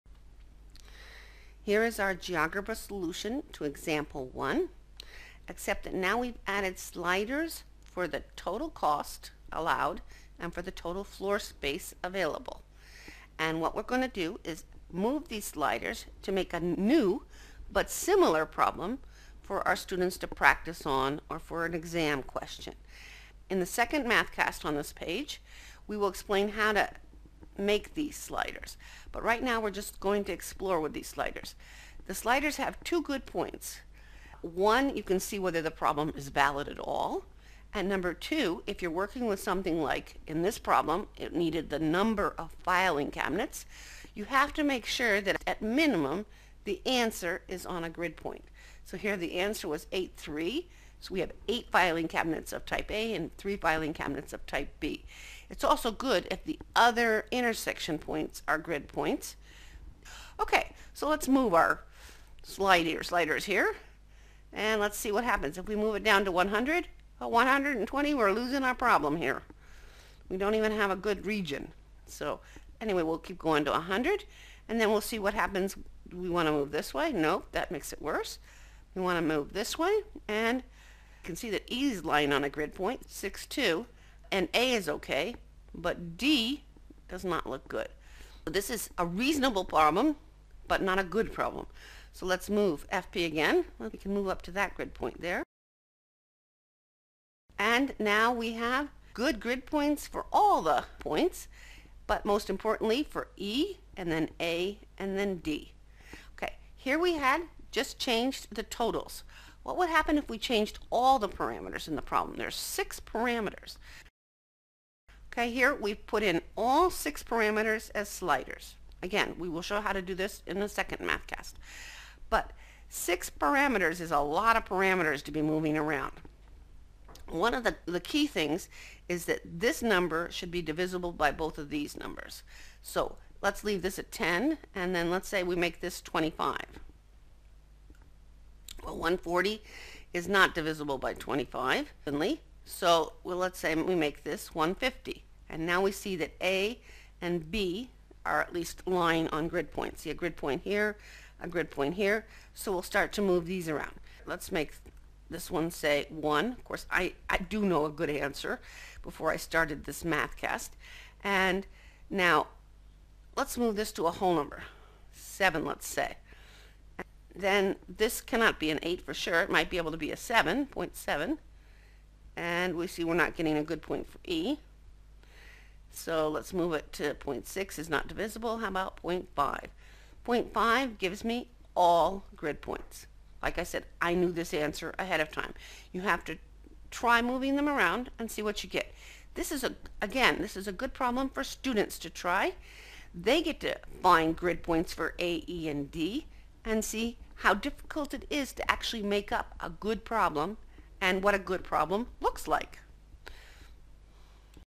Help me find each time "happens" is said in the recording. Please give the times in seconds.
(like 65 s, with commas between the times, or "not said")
65 s, 75 s, 109 s.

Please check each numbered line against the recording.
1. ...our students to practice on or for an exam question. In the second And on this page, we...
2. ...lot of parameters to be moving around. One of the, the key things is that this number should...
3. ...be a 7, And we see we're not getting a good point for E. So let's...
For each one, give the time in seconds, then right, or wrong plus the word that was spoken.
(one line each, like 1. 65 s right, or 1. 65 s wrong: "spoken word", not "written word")
1. 19 s wrong: "MathCast", not "And"
2. 124 s right
3. 169 s right.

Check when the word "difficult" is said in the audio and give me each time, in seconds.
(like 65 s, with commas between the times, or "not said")
197 s.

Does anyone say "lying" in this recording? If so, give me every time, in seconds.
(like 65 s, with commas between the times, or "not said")
82 s, 148 s.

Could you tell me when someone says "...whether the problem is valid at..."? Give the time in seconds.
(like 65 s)
35 s.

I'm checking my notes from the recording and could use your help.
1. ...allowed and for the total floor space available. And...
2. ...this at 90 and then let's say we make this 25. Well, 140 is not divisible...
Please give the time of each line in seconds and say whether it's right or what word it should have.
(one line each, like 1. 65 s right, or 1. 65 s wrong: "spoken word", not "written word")
1. 9 s right
2. 133 s wrong: "10", not "90".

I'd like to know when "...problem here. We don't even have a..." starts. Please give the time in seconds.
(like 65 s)
68 s.